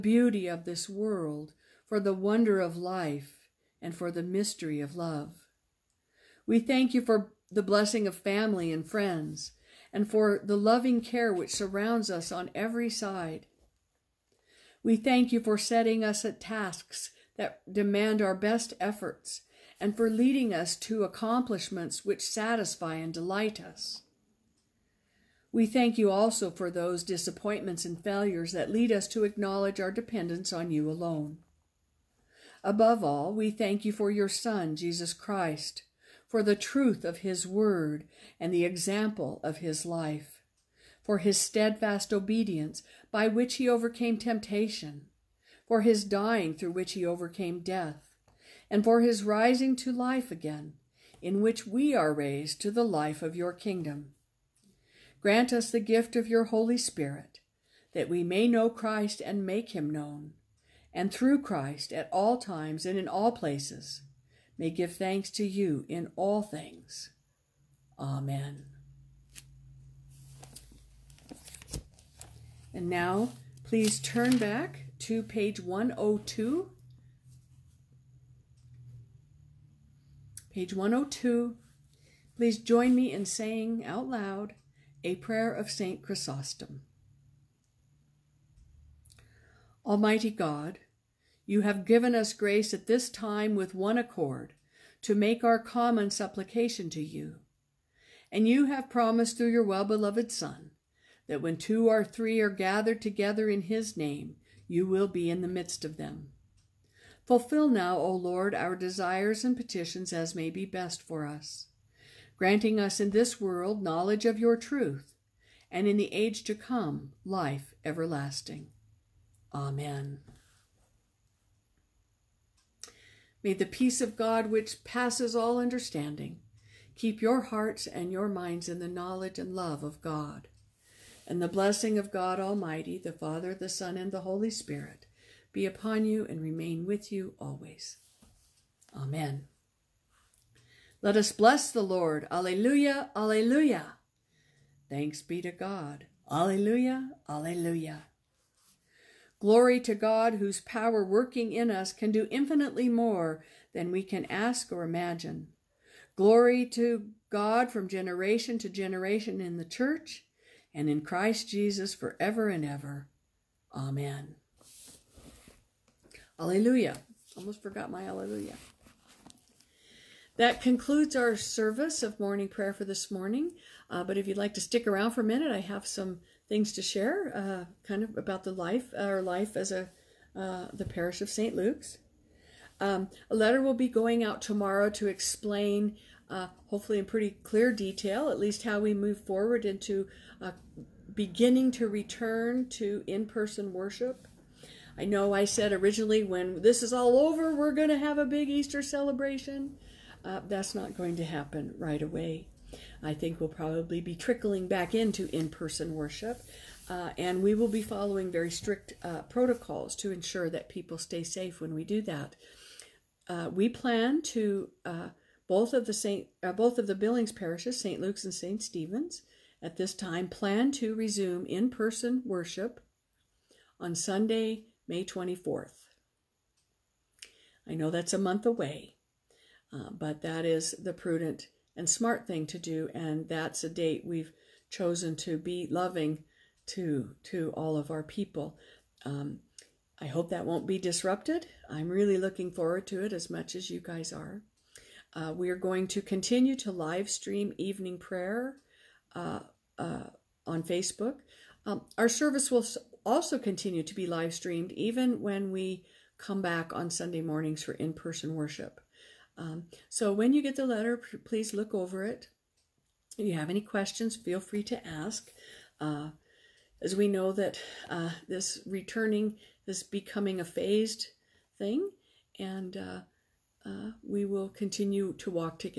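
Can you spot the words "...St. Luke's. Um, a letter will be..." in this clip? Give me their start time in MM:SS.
03:01.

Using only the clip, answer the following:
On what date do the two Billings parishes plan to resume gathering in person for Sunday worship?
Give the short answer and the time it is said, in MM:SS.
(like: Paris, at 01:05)
May 24, at 03:44.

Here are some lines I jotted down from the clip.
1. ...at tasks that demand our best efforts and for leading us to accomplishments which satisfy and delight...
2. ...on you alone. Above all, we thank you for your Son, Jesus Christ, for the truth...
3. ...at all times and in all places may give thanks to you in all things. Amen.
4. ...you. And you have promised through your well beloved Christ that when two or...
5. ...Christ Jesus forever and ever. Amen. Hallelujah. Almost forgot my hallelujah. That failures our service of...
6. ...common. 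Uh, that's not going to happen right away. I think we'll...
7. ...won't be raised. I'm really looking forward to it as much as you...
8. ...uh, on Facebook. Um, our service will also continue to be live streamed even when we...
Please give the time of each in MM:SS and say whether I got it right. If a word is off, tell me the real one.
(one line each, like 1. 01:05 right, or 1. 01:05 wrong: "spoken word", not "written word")
1. 00:16 right
2. 00:30 right
3. 01:01 right
4. 01:37 wrong: "Son", not "Christ"
5. 02:41 wrong: "concludes", not "failures"
6. 03:18 wrong: "celebration", not "common"
7. 04:00 wrong: "disrupted", not "raised"
8. 04:09 right.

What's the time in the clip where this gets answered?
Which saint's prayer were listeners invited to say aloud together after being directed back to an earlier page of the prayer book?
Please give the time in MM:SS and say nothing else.
01:25.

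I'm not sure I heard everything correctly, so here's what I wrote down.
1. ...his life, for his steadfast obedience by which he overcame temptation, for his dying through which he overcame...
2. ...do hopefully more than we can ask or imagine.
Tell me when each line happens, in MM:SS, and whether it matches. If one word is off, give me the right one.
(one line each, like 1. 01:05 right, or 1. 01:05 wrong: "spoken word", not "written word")
1. 00:39 right
2. 02:32 wrong: "infinitely", not "hopefully".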